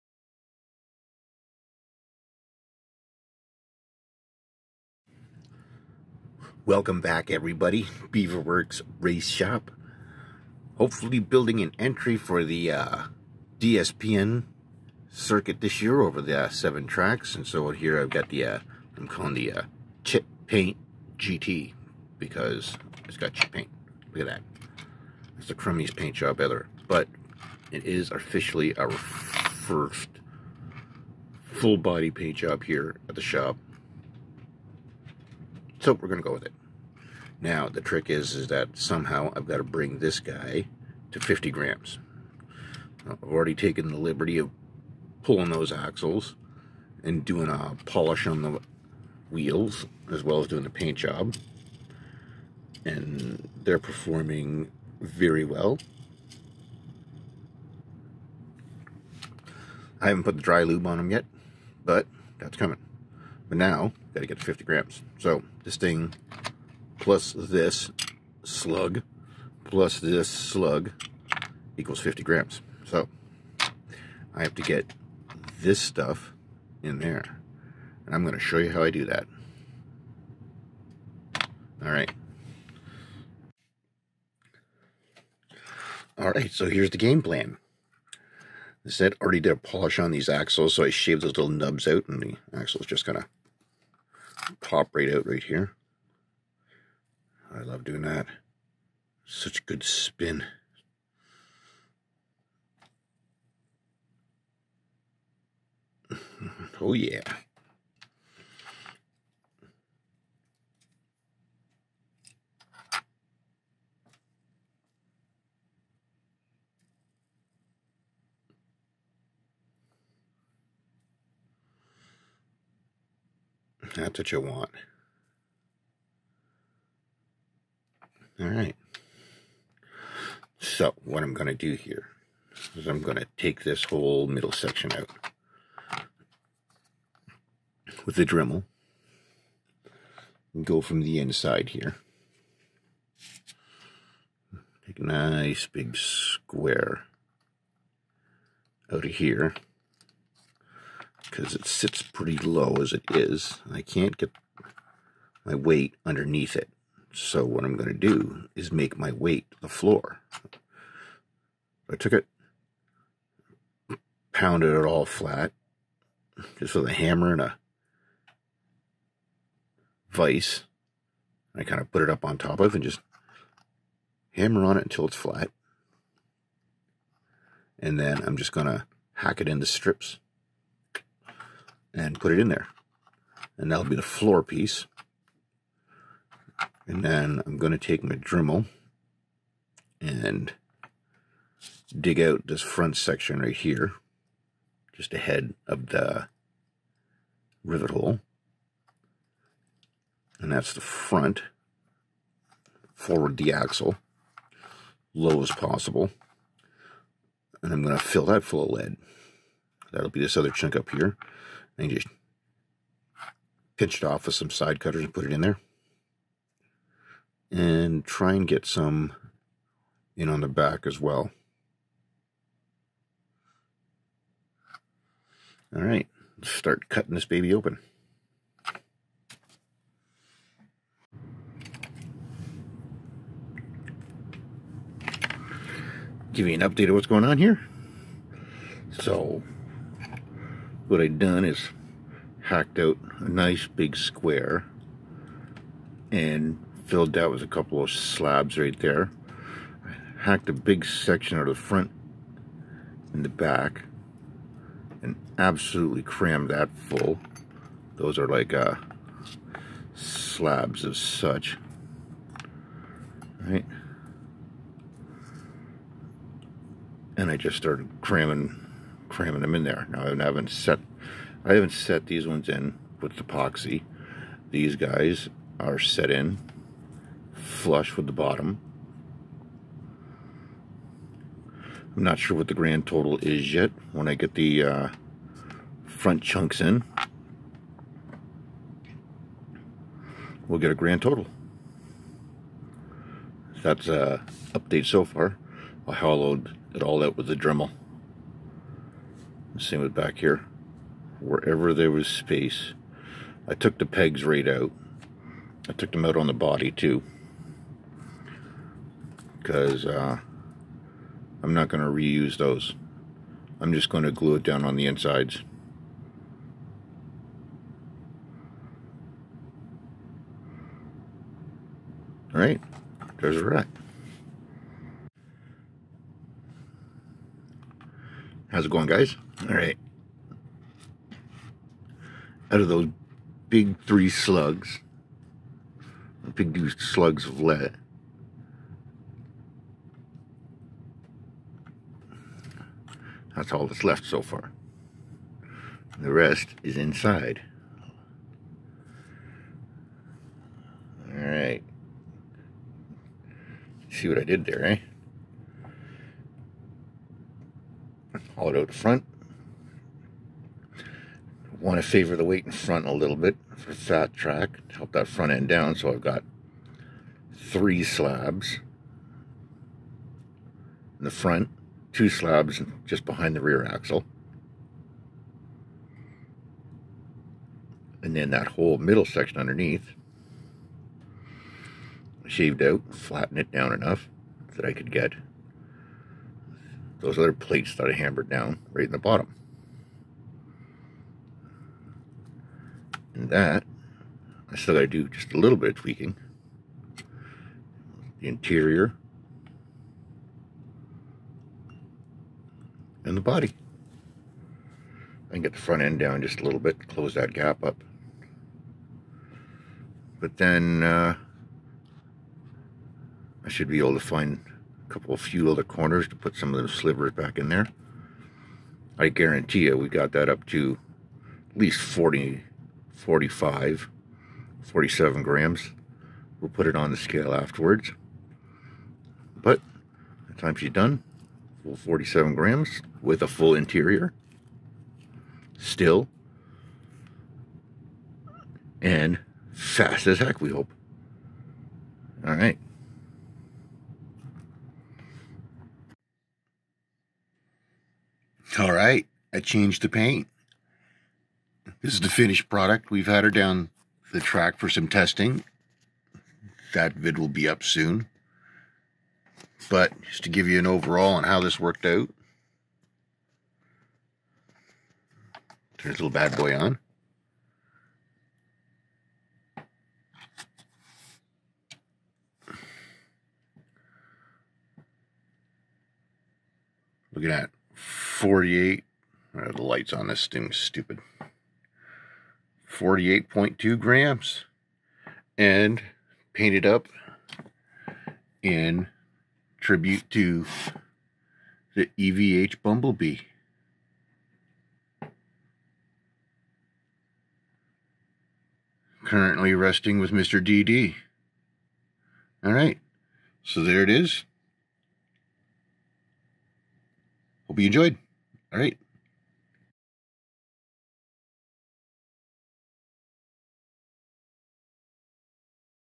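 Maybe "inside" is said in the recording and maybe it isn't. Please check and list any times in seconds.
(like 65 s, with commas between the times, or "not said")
141 s, 314 s, 346 s.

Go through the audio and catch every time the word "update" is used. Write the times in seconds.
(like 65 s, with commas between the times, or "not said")
236 s, 294 s.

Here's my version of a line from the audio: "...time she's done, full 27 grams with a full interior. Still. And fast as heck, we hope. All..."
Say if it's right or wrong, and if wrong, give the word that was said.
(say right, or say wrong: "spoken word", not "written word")
wrong: "47", not "27".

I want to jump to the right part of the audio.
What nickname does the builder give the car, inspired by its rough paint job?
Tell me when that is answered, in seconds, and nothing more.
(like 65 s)
20 s.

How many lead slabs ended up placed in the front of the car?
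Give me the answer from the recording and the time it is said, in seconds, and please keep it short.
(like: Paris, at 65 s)
3, at 367 s.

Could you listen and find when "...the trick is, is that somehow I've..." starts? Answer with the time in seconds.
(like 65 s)
37 s.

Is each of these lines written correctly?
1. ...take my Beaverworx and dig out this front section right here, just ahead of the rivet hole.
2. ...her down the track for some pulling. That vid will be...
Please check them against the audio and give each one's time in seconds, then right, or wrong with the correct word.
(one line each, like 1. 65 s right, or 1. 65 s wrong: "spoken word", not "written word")
1. 187 s wrong: "Dremel", not "Beaverworx"
2. 453 s wrong: "testing", not "pulling".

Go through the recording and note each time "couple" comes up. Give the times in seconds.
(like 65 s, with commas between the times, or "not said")
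247 s, 414 s.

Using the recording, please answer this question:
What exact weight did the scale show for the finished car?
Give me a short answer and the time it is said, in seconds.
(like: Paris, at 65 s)
48.2 grams, at 482 s.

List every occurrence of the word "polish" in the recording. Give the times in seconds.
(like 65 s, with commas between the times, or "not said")
47 s, 89 s.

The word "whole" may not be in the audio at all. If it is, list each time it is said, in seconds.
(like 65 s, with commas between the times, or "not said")
133 s, 378 s.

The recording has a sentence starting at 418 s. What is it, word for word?
I guarantee you we got that up to at least 40 45, 47 grams.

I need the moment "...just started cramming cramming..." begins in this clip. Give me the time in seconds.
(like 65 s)
267 s.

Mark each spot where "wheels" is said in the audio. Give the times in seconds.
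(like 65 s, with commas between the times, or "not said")
49 s.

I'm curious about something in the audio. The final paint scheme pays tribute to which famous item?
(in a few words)
EVH Bumblebee.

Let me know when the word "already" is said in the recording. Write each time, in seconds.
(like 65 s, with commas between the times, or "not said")
43 s, 89 s.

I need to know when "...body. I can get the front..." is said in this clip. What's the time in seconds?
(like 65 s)
403 s.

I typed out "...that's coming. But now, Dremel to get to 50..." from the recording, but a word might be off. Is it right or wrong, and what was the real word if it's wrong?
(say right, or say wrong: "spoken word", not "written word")
wrong: "Got", not "Dremel".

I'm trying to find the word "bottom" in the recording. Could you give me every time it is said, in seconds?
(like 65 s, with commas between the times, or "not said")
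278 s, 388 s.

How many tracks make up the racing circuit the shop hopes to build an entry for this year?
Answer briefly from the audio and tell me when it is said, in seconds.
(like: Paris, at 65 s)
7, at 16 s.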